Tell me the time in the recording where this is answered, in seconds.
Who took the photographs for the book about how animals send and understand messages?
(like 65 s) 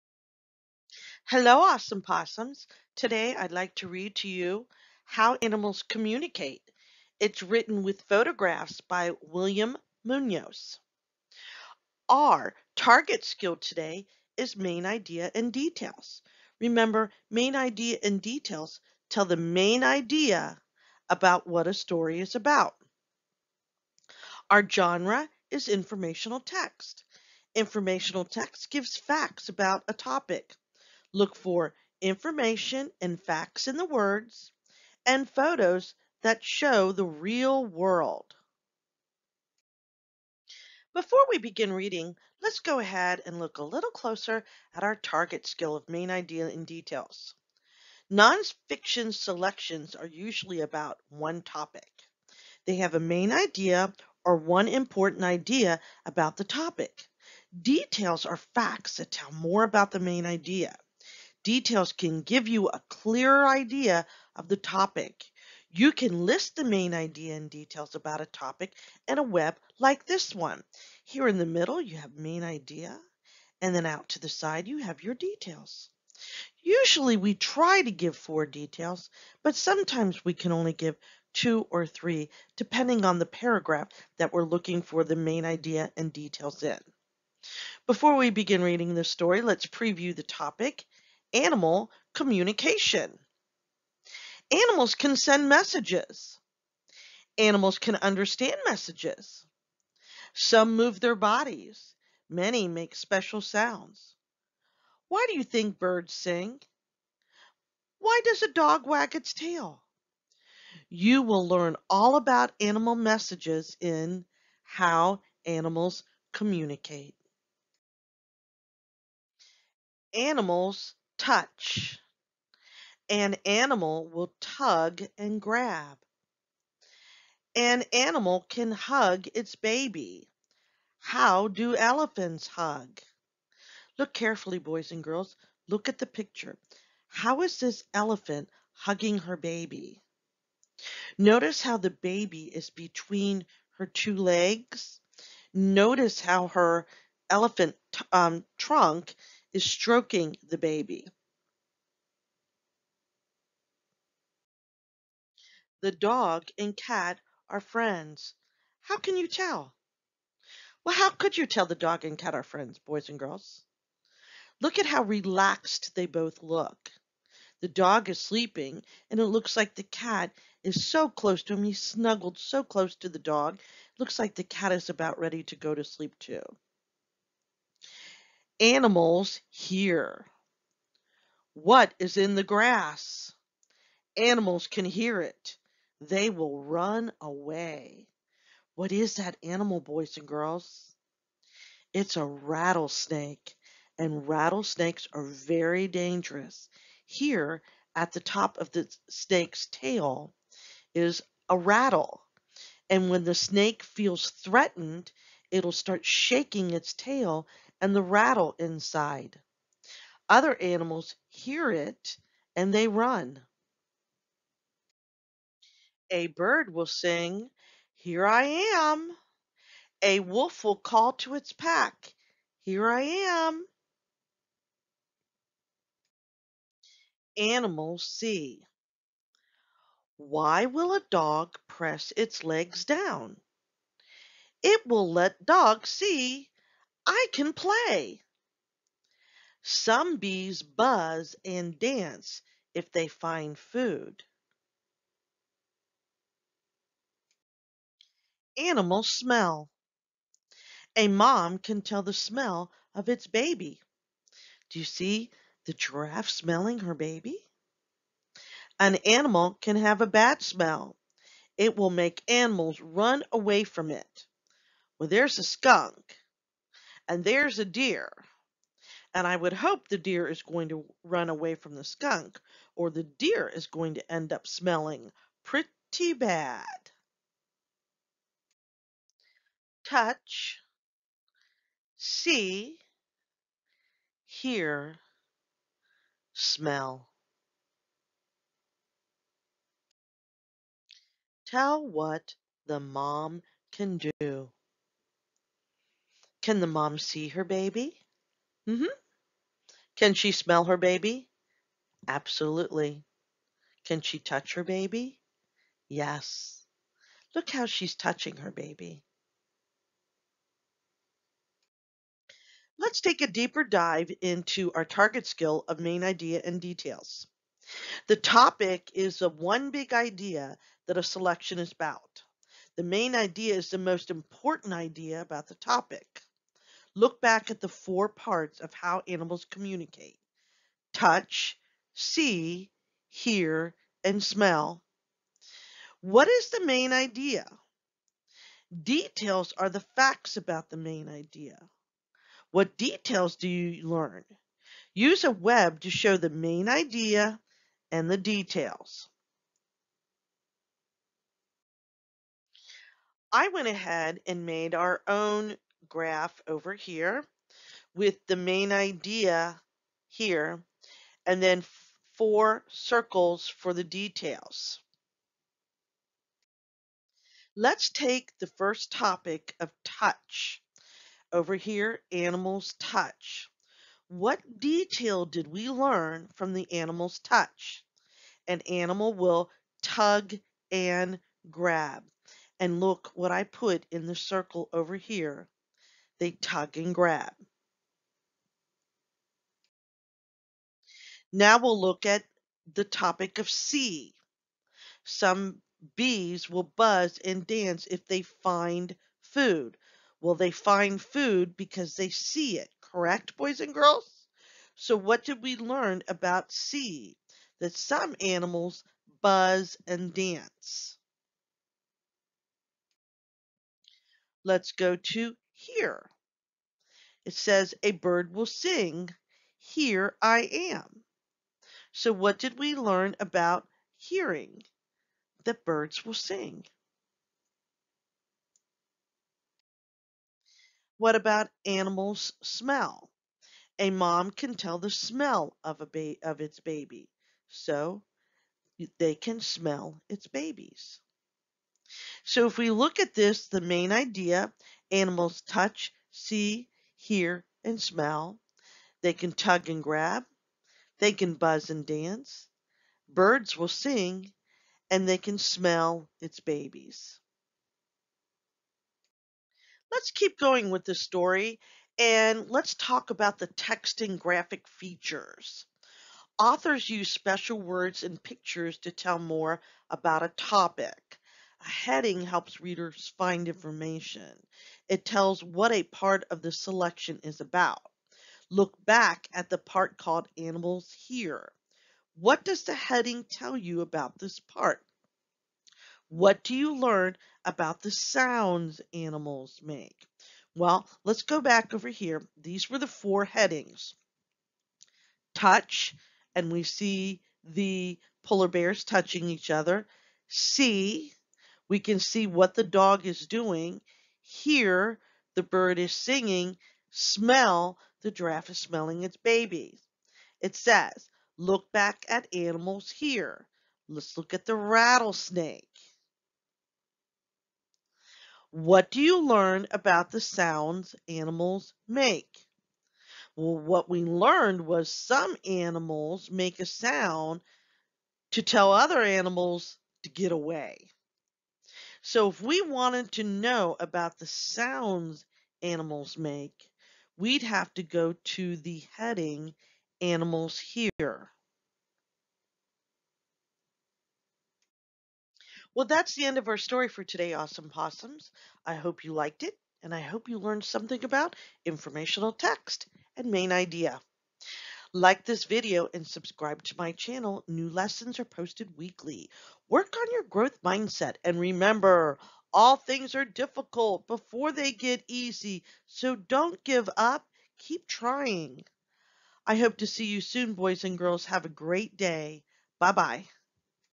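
9 s.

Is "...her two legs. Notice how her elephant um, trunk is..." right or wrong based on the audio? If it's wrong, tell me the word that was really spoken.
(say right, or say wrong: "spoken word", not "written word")
right.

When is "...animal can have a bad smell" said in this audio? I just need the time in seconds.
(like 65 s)
259 s.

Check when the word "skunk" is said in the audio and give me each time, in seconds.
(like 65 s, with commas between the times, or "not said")
265 s, 271 s.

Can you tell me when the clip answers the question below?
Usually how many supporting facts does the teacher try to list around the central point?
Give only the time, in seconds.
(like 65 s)
78 s.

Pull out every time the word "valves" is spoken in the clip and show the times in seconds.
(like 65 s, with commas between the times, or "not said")
not said.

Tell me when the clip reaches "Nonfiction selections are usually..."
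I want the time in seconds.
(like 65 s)
48 s.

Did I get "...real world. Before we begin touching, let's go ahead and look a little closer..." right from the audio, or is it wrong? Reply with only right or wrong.
wrong.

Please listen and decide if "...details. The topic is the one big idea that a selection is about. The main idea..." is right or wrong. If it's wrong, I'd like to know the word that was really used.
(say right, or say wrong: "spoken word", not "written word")
right.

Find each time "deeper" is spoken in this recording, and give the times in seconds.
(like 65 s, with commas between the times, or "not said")
313 s.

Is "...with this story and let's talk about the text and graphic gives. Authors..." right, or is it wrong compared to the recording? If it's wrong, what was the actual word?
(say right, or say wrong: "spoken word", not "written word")
wrong: "features", not "gives".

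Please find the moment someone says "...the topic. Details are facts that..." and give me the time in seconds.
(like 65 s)
56 s.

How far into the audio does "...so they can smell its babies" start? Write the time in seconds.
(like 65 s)
437 s.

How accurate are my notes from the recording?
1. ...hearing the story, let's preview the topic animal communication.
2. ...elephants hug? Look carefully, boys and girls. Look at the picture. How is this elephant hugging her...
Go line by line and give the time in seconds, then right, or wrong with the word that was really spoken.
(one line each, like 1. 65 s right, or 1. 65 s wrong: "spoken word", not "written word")
1. 88 s wrong: "reading", not "hearing"
2. 131 s right.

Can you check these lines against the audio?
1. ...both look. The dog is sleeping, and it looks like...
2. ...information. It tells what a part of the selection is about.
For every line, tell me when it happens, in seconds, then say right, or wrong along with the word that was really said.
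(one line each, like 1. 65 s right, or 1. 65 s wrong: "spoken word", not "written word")
1. 166 s right
2. 473 s right.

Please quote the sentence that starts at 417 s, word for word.
It says, A bird will sing, Here I am.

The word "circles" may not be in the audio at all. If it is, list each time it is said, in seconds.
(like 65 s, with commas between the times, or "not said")
362 s, 384 s.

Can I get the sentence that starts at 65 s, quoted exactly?
You can list the main idea and details about a topic in a web like this one.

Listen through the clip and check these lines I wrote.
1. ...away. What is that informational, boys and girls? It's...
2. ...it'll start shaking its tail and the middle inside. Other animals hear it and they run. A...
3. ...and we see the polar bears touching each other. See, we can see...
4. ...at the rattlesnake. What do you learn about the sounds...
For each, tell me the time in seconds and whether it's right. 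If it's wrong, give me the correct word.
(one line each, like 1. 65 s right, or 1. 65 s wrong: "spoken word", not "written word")
1. 187 s wrong: "animal", not "informational"
2. 205 s wrong: "rattle", not "middle"
3. 496 s right
4. 514 s right.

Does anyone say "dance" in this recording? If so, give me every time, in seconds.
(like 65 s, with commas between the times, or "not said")
241 s, 397 s, 410 s, 451 s.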